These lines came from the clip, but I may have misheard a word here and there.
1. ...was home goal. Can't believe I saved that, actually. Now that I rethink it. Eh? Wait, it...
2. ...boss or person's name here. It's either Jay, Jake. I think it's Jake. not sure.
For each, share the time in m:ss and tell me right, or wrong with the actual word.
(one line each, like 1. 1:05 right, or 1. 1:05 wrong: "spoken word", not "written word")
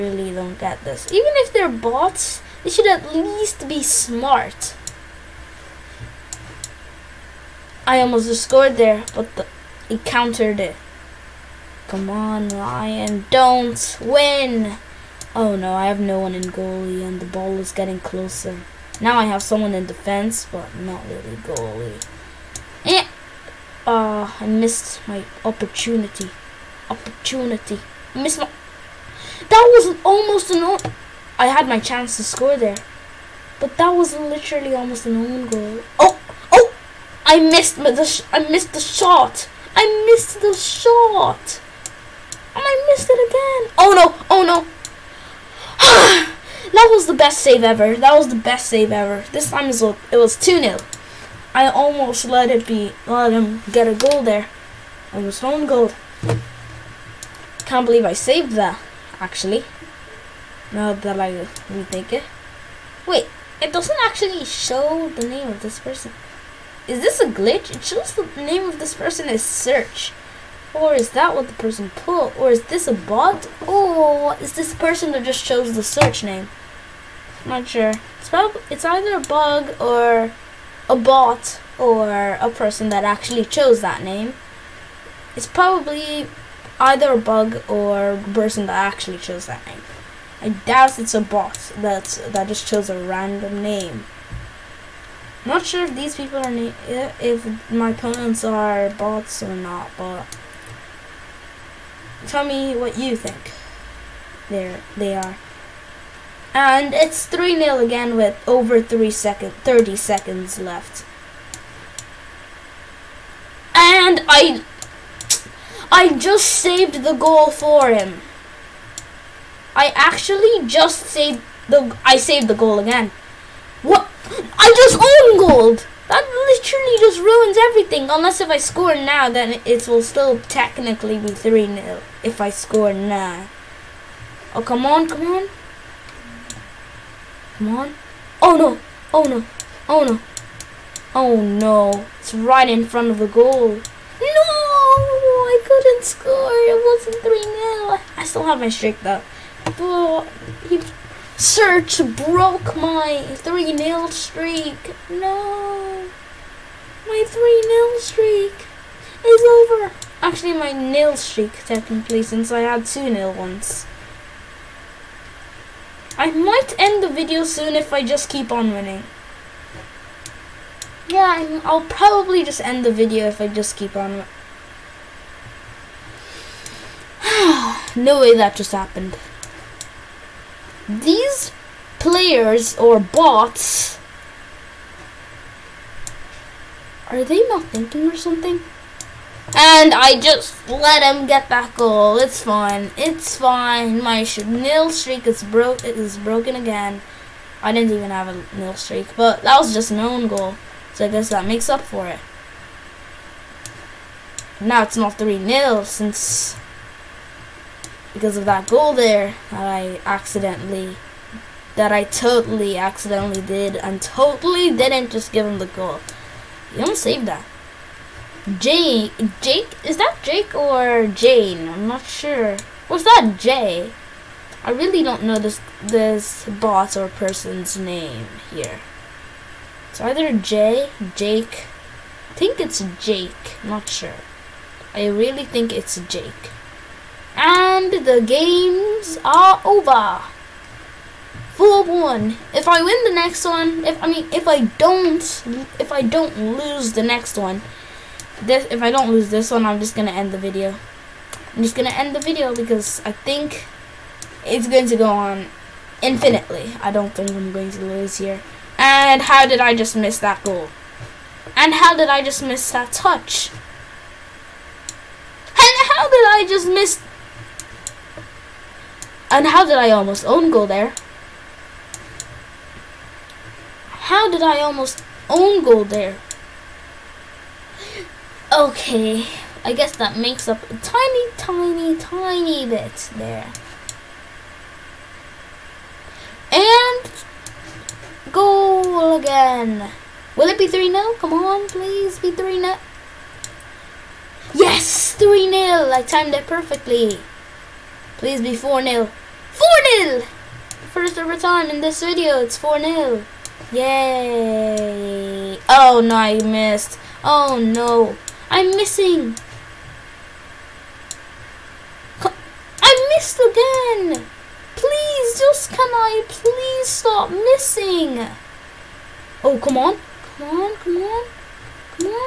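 1. 0:55 right
2. 3:46 right.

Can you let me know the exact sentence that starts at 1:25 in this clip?
It's probably either a bug or a person that actually chose that name.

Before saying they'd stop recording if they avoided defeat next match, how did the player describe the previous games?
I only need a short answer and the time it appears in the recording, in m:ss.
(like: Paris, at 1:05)
Full one, at 4:01.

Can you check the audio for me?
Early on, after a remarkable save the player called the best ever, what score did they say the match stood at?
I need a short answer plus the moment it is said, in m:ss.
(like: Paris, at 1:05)
2-0, at 0:49.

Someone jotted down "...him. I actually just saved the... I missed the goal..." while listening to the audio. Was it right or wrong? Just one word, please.
wrong.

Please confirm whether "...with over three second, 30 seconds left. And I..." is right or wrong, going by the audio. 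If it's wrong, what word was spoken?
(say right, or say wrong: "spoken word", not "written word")
right.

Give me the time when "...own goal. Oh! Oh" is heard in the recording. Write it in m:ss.
0:35.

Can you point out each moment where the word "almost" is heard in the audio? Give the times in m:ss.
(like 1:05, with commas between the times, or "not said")
0:08, 0:30, 0:34, 0:51, 4:29, 4:34.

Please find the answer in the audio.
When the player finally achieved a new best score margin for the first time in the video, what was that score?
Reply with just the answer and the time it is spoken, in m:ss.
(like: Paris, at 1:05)
4-0, at 4:59.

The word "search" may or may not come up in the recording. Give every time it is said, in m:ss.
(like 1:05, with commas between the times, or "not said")
1:09, 1:15, 2:31.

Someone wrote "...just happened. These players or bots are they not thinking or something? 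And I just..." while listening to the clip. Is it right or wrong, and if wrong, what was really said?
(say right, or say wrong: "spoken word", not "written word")
right.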